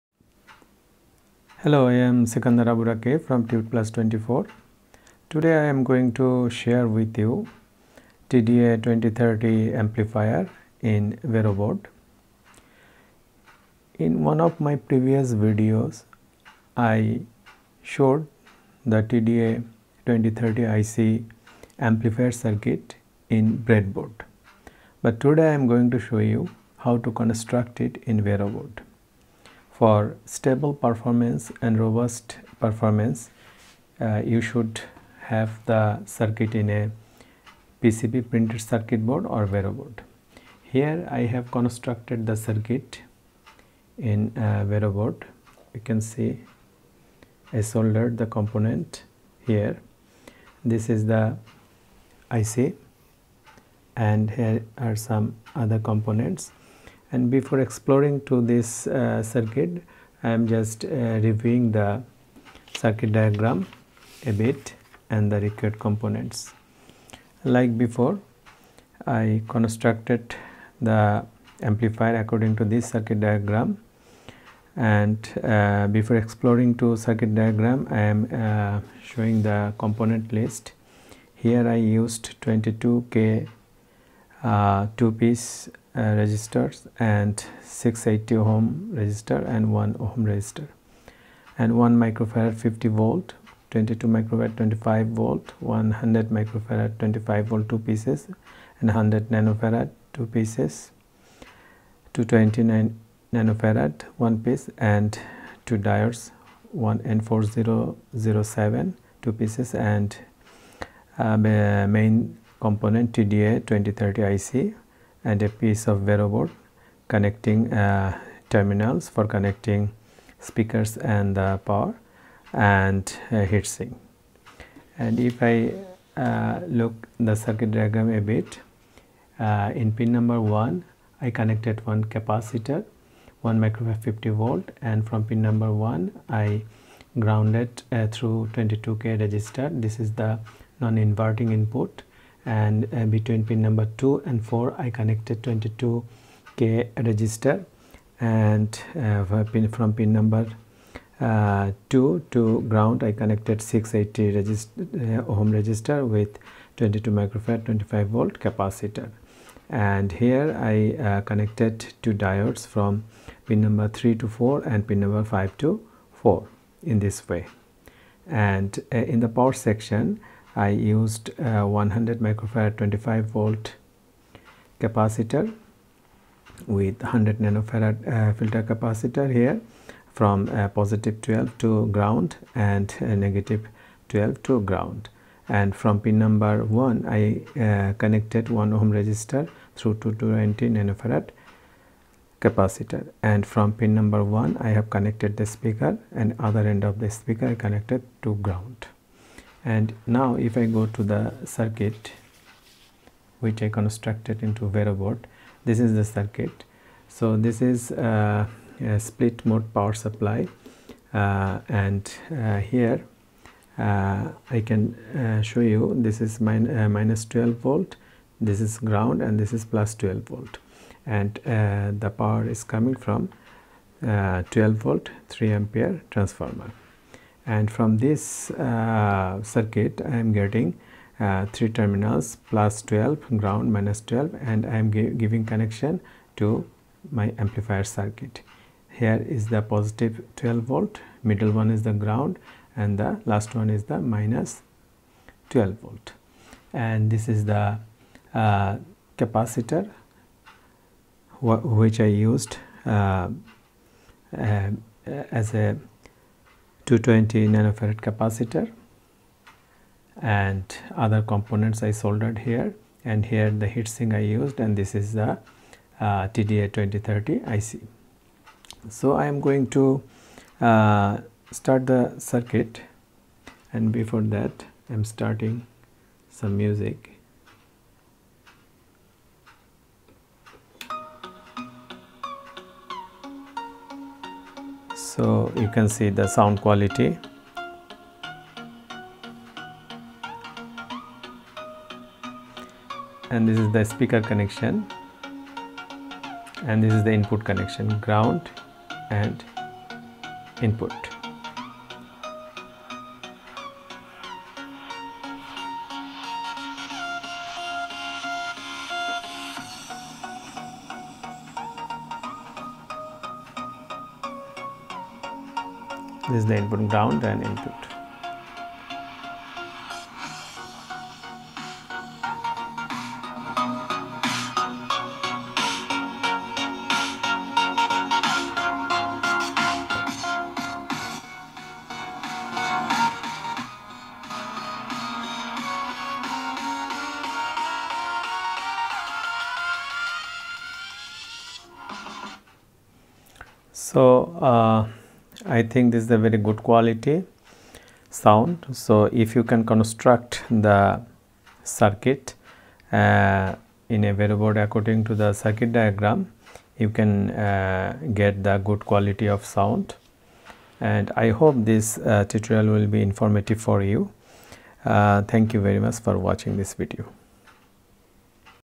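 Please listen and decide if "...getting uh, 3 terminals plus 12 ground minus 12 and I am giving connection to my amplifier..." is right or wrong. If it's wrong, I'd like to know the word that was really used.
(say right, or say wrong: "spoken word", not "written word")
right.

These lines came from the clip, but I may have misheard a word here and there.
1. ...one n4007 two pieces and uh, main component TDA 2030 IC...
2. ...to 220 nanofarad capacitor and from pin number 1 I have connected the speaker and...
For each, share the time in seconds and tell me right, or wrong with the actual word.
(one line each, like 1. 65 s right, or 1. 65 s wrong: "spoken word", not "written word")
1. 106 s right
2. 189 s right.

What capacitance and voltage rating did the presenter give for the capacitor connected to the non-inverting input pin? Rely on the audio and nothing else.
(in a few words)
1 microfarad, 50 volt.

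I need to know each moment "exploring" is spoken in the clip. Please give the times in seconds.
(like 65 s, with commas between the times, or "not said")
57 s, 76 s.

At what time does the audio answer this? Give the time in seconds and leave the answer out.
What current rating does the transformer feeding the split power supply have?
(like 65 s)
225 s.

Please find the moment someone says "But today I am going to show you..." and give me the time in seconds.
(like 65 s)
25 s.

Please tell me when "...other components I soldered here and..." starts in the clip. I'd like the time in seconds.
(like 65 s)
261 s.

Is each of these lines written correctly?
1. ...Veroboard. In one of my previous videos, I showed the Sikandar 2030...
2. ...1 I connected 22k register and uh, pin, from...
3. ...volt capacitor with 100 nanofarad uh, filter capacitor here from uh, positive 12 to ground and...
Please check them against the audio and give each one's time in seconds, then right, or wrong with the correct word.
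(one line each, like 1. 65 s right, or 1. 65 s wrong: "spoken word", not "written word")
1. 11 s wrong: "TDA", not "Sikandar"
2. 144 s wrong: "4", not "1"
3. 173 s right.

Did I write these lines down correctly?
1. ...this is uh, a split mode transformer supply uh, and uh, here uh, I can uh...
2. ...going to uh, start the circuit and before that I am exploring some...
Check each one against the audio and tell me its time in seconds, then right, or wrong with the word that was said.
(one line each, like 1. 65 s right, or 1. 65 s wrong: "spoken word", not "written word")
1. 207 s wrong: "power", not "transformer"
2. 269 s wrong: "starting", not "exploring".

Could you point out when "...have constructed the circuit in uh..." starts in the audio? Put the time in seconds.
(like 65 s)
41 s.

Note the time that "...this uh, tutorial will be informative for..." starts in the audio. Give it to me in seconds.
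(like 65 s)
361 s.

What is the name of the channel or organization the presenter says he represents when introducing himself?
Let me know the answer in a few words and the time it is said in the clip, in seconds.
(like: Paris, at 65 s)
Tutplus 24, at 3 s.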